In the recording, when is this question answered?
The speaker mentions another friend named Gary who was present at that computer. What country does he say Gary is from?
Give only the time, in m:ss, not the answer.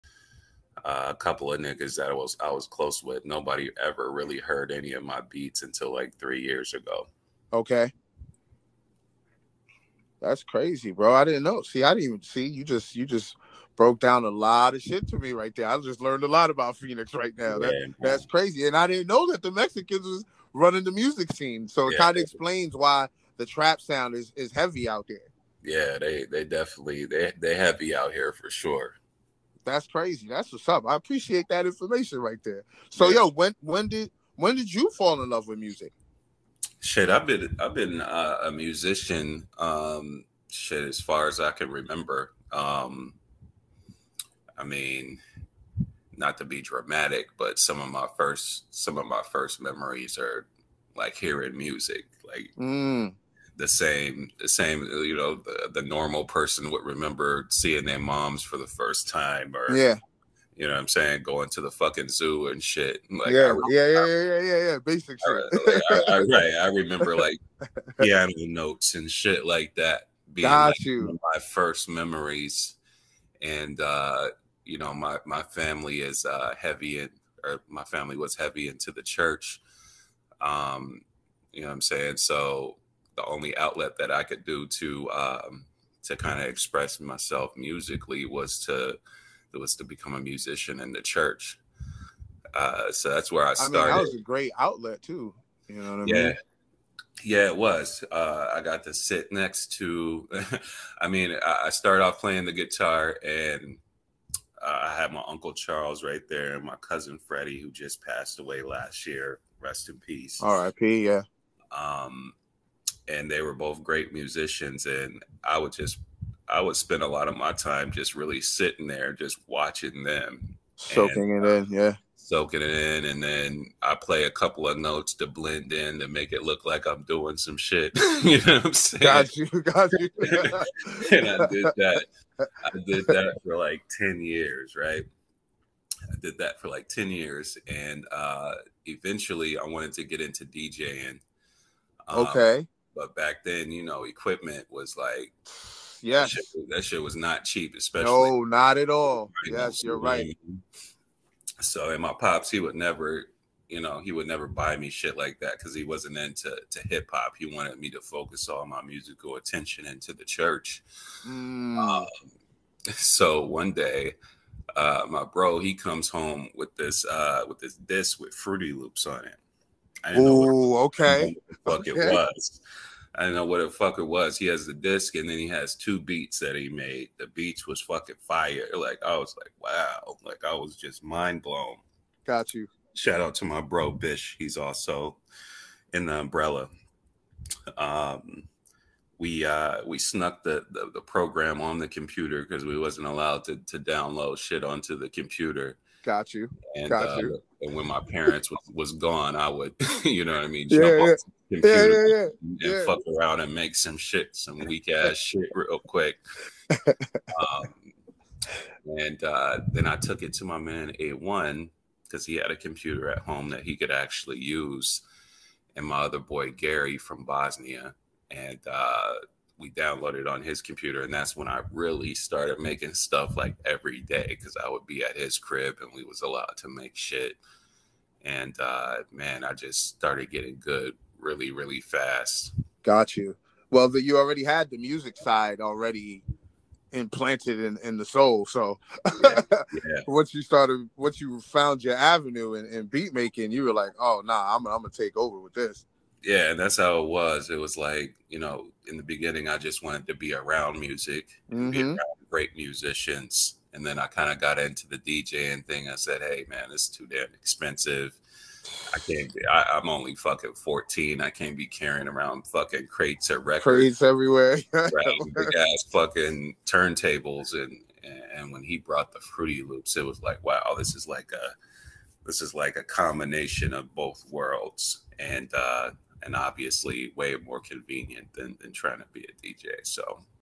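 3:37.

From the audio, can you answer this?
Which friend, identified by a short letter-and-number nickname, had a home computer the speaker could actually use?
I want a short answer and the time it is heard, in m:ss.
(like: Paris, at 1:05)
A1, at 3:31.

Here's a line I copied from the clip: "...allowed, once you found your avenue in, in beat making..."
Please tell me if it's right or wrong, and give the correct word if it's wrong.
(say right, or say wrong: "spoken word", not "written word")
wrong: "started", not "allowed".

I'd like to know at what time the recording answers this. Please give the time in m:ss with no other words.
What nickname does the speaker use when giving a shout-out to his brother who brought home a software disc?
3:03.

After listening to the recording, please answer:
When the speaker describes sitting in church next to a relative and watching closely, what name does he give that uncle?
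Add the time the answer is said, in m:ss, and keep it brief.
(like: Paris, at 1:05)
Charles, at 1:45.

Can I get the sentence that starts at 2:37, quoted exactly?
He wanted me to focus all my musical attention into the church.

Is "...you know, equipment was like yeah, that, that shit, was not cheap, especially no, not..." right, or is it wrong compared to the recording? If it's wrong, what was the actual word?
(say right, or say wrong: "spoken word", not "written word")
right.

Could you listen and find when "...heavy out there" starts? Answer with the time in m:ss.
0:24.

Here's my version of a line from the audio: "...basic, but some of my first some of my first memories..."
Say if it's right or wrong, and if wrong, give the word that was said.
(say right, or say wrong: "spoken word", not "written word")
wrong: "dramatic", not "basic".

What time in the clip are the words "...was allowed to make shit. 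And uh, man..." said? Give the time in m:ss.
3:46.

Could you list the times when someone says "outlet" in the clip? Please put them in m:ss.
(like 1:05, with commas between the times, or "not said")
1:23, 1:34.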